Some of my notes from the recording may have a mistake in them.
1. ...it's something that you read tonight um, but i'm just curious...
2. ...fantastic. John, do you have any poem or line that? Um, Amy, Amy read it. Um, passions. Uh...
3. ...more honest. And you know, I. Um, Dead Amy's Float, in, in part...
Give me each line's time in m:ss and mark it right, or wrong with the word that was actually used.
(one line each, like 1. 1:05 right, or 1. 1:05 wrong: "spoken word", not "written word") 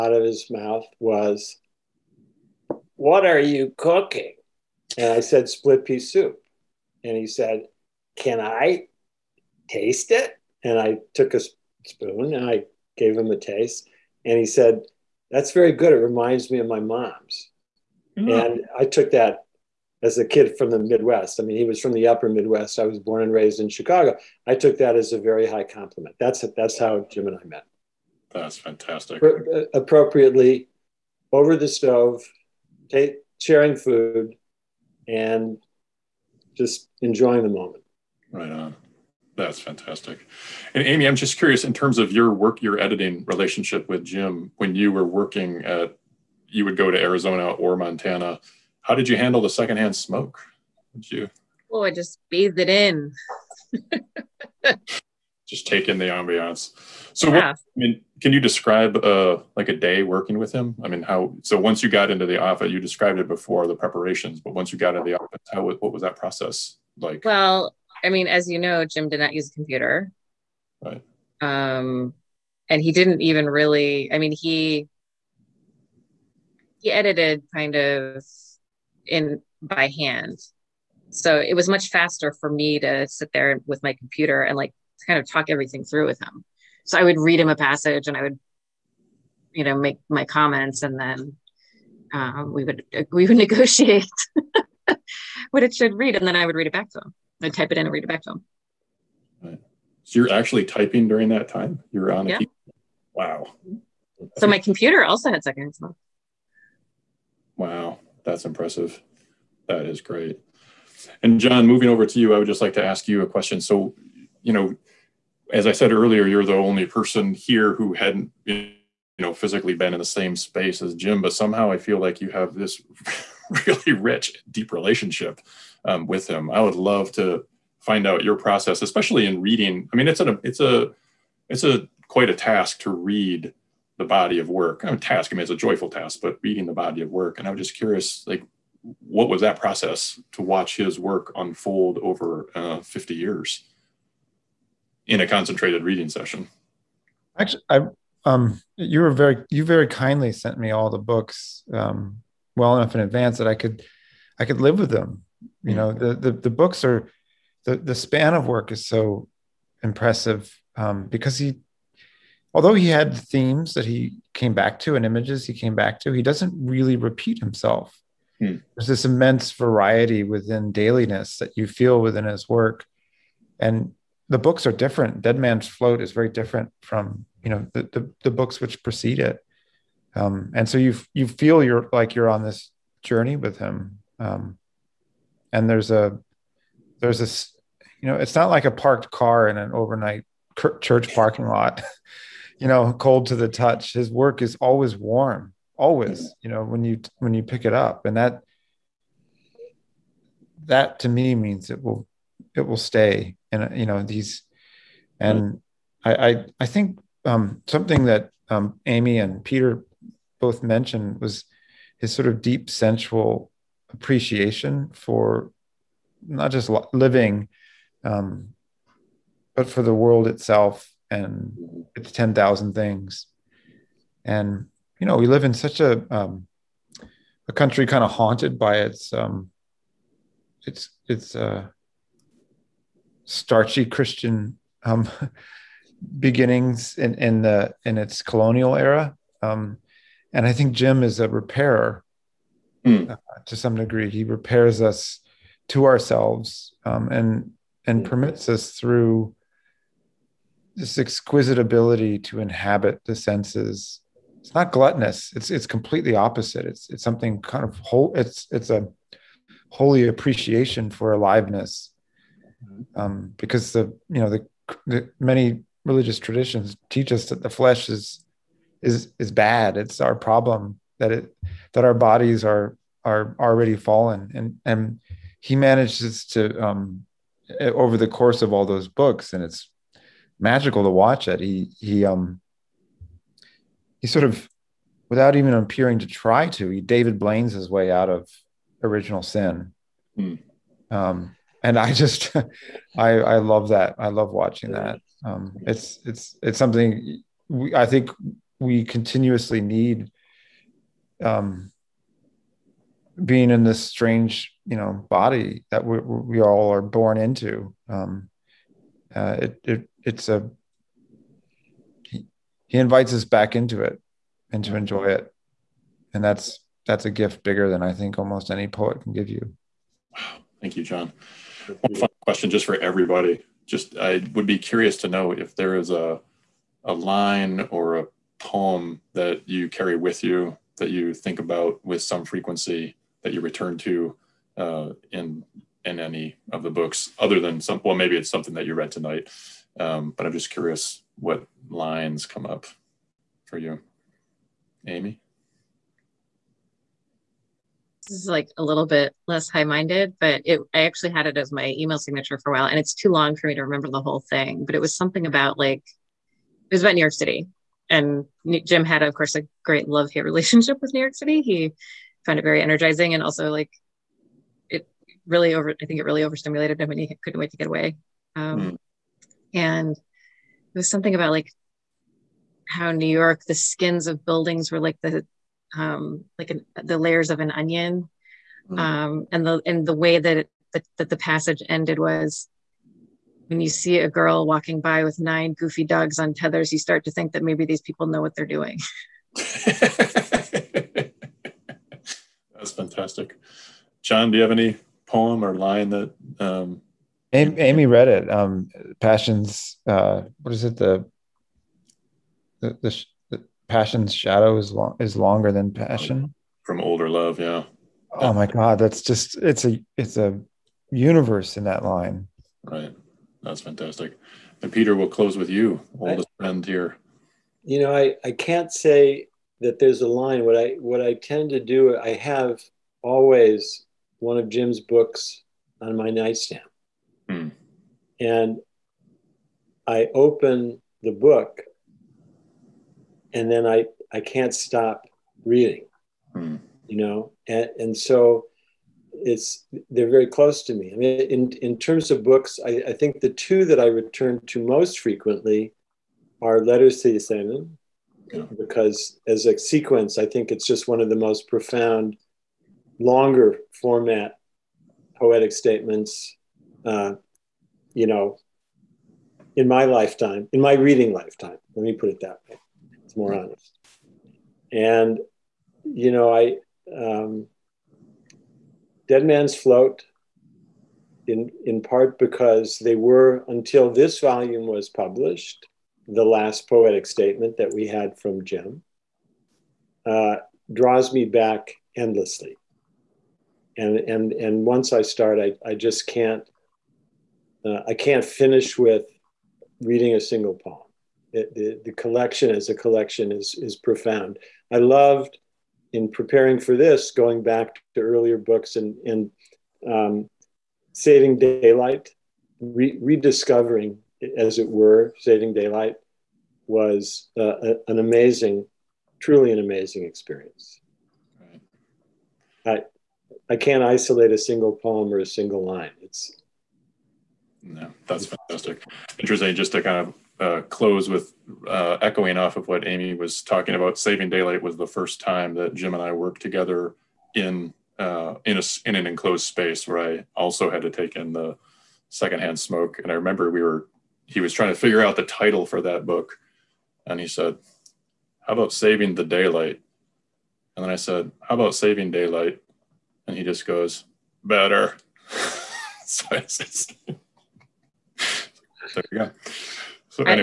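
1. 5:38 right
2. 6:32 right
3. 7:43 wrong: "Man", not "Amy".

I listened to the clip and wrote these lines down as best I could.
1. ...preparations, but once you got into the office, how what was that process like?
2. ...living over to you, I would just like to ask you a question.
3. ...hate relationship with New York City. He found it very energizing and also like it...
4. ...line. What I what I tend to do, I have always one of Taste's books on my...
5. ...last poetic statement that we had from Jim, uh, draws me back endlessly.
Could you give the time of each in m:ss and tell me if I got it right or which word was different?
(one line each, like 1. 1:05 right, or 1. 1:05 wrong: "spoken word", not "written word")
1. 1:03 right
2. 1:51 wrong: "moving", not "living"
3. 6:00 right
4. 7:00 wrong: "Jim", not "Taste"
5. 7:56 right.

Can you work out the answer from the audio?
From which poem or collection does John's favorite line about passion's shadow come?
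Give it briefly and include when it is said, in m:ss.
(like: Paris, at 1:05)
Older Love, at 6:46.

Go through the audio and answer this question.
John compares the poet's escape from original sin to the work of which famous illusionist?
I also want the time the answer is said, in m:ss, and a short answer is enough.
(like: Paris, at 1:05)
David Blaine, at 4:46.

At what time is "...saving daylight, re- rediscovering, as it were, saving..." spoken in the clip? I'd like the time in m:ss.
8:20.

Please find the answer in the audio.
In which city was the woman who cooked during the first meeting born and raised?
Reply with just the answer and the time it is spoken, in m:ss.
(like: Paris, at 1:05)
Chicago, at 0:23.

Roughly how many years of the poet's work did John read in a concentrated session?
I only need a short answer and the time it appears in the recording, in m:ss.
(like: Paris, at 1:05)
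50, at 2:22.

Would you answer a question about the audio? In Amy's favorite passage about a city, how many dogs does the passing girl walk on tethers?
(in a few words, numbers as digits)
9.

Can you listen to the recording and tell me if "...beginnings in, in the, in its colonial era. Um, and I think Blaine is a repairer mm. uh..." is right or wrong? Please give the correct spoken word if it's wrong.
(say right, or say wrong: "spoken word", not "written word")
wrong: "Jim", not "Blaine".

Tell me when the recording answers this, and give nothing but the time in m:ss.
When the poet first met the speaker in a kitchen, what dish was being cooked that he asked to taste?
0:05.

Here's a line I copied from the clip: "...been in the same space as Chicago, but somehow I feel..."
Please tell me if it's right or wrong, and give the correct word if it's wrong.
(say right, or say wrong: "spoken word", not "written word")
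wrong: "Jim", not "Chicago".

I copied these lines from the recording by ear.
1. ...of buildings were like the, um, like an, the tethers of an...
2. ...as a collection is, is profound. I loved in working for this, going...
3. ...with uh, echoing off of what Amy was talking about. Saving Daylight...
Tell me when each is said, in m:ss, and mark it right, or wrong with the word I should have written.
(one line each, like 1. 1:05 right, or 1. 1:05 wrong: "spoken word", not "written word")
1. 6:14 wrong: "layers", not "tethers"
2. 8:12 wrong: "preparing", not "working"
3. 8:41 right.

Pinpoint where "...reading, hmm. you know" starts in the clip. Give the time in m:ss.
7:15.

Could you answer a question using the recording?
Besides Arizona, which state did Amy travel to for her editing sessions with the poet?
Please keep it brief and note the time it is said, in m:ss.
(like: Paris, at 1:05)
Montana, at 0:47.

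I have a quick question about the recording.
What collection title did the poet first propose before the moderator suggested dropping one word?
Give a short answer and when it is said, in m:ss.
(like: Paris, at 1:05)
Saving the Daylight, at 8:58.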